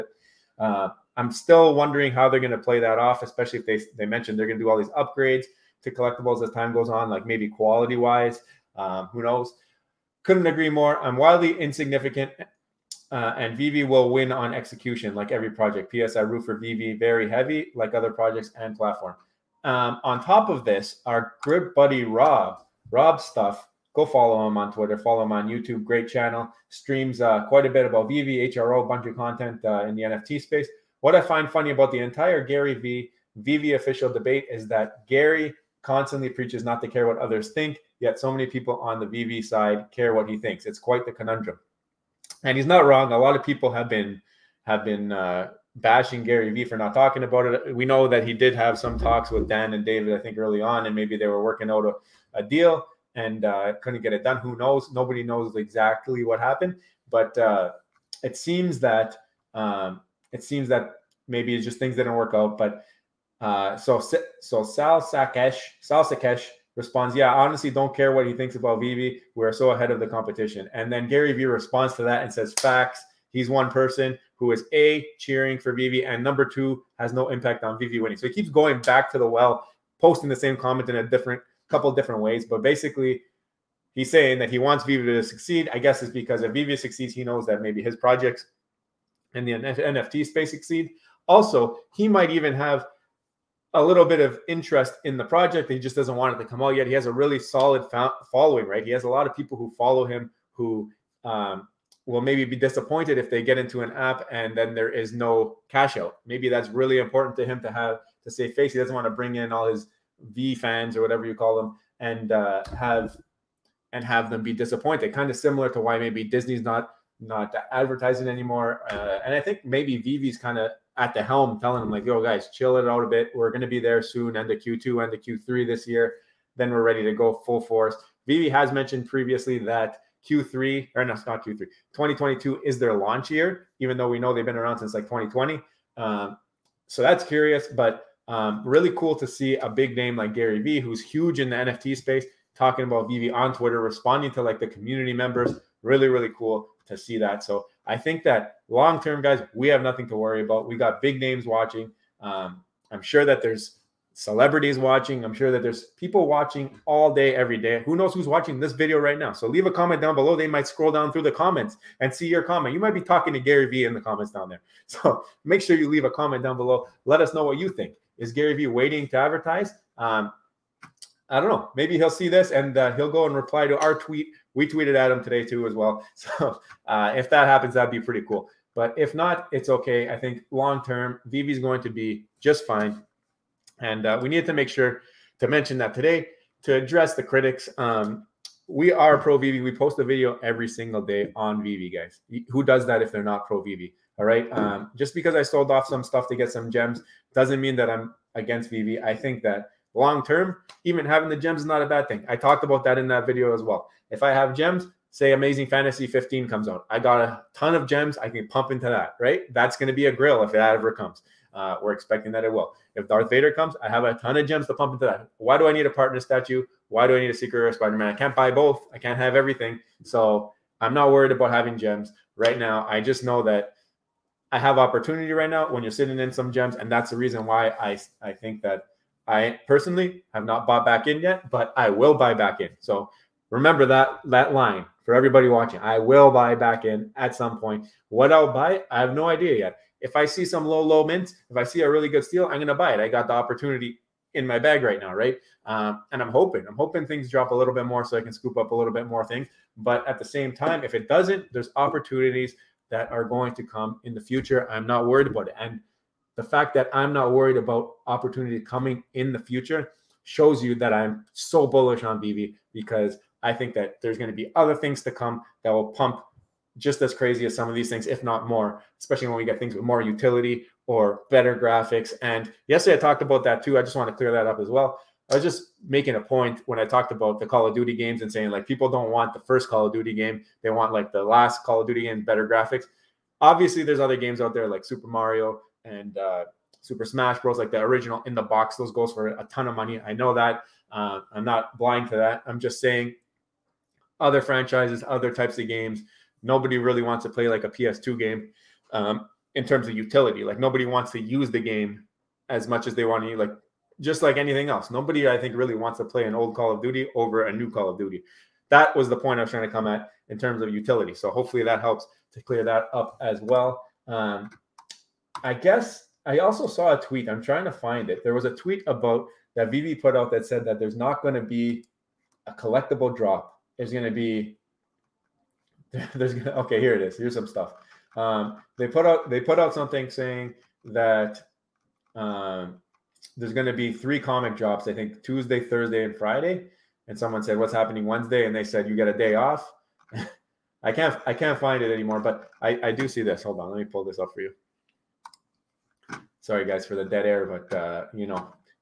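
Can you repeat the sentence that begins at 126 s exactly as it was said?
Then we're ready to go full force.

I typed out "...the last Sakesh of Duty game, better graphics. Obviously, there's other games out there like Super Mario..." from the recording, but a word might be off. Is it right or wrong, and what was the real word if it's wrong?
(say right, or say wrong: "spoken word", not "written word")
wrong: "Call", not "Sakesh".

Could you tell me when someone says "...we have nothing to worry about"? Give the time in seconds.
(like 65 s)
149 s.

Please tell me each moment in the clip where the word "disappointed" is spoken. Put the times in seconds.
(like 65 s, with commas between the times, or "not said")
102 s, 114 s.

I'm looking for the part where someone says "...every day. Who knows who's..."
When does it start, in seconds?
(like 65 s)
157 s.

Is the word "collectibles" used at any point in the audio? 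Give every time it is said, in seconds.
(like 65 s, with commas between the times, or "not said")
5 s, 322 s.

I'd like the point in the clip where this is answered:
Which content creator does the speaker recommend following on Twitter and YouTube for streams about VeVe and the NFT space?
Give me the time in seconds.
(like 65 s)
22 s.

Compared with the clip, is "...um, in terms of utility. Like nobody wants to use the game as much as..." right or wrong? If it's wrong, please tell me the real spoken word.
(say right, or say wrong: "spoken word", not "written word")
right.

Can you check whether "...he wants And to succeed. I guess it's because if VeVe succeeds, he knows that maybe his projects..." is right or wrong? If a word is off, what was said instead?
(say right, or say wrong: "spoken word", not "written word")
wrong: "VeVe", not "And".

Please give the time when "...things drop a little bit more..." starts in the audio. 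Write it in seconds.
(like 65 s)
247 s.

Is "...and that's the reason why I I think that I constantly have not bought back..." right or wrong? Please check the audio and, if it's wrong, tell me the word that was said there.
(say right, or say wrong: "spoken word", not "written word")
wrong: "personally", not "constantly".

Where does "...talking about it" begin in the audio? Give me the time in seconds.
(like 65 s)
46 s.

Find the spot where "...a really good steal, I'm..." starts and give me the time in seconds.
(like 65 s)
241 s.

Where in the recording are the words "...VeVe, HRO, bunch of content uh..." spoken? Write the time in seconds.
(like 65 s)
28 s.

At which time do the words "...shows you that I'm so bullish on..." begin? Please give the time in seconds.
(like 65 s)
260 s.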